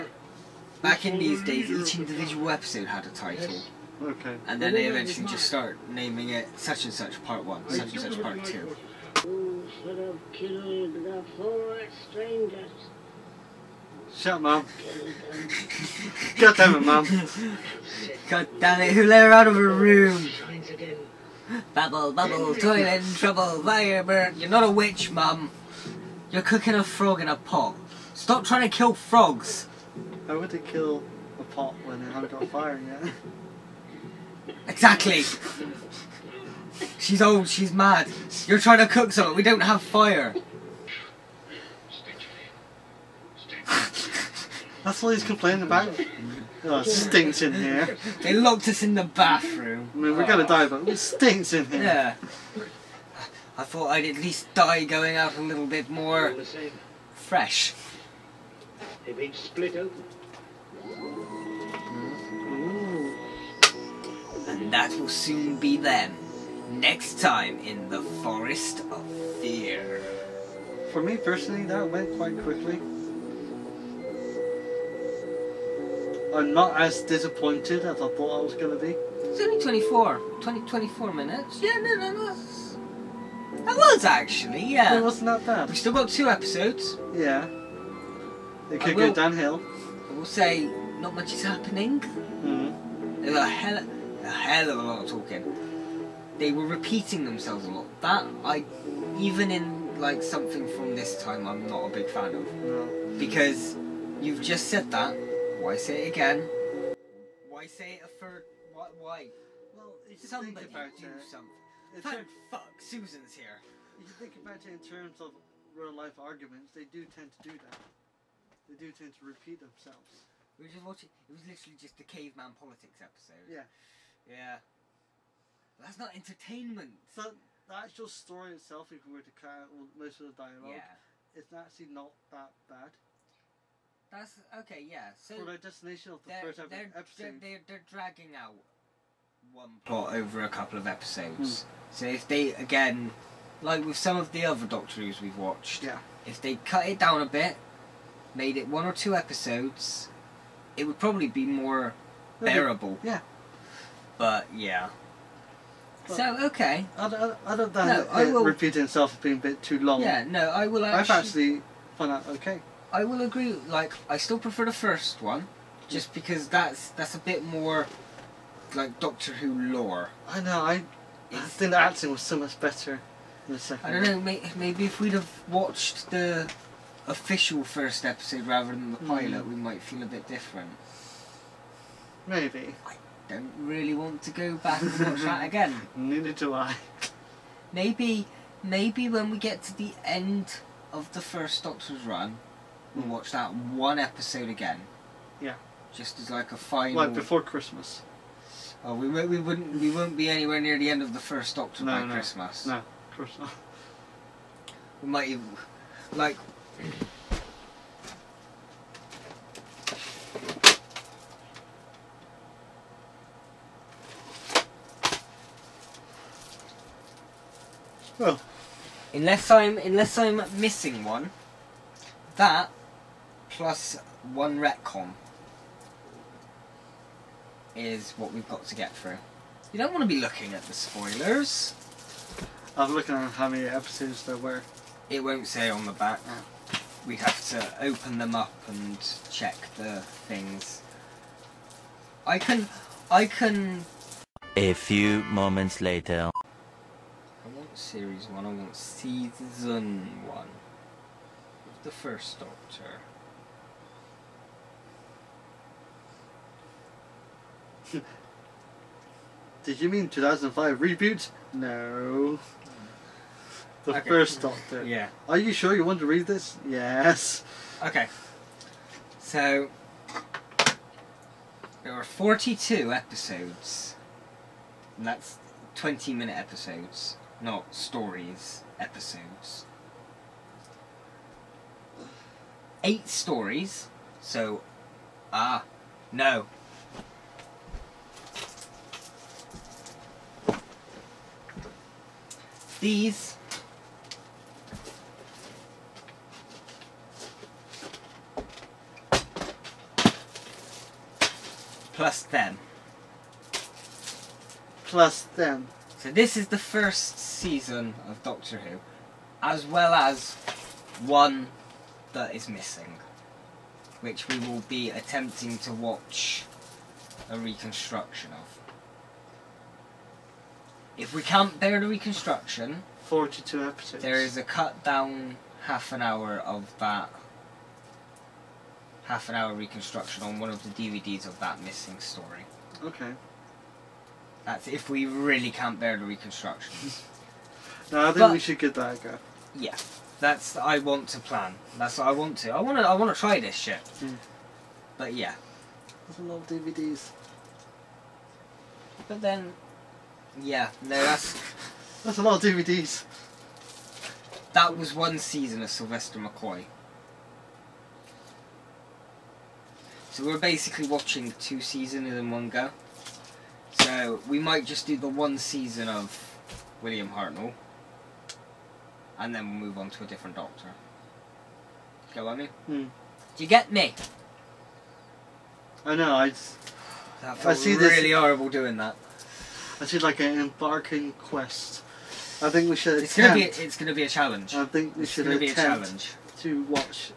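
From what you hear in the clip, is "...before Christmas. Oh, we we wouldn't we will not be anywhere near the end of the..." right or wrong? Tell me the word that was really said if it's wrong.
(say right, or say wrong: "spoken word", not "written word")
right.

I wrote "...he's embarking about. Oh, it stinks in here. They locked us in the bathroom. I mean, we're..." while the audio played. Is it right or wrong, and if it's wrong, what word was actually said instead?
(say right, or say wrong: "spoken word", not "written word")
wrong: "complaining", not "embarking".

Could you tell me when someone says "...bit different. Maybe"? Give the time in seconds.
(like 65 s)
180 s.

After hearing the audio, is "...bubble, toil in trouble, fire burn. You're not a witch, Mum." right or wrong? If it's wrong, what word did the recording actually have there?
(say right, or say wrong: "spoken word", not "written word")
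right.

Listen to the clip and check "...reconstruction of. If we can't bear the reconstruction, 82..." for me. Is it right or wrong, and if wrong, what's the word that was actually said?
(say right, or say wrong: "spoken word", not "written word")
wrong: "42", not "82".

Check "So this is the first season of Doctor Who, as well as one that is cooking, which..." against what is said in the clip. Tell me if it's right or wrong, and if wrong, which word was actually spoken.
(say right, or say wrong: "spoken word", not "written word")
wrong: "missing", not "cooking".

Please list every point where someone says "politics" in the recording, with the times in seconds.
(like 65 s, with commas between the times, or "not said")
122 s.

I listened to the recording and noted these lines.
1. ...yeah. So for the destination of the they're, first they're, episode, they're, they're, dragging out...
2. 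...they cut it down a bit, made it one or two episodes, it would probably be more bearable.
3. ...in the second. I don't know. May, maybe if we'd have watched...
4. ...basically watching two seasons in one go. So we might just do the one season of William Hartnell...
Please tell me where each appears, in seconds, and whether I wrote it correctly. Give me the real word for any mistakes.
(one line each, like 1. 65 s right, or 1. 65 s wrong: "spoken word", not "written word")
1. 134 s right
2. 146 s right
3. 173 s right
4. 360 s right.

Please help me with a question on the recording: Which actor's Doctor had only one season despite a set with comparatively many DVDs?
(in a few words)
Sylvester McCoy.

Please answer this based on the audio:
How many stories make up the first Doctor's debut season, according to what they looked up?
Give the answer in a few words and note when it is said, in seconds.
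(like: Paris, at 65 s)
Eight, at 282 s.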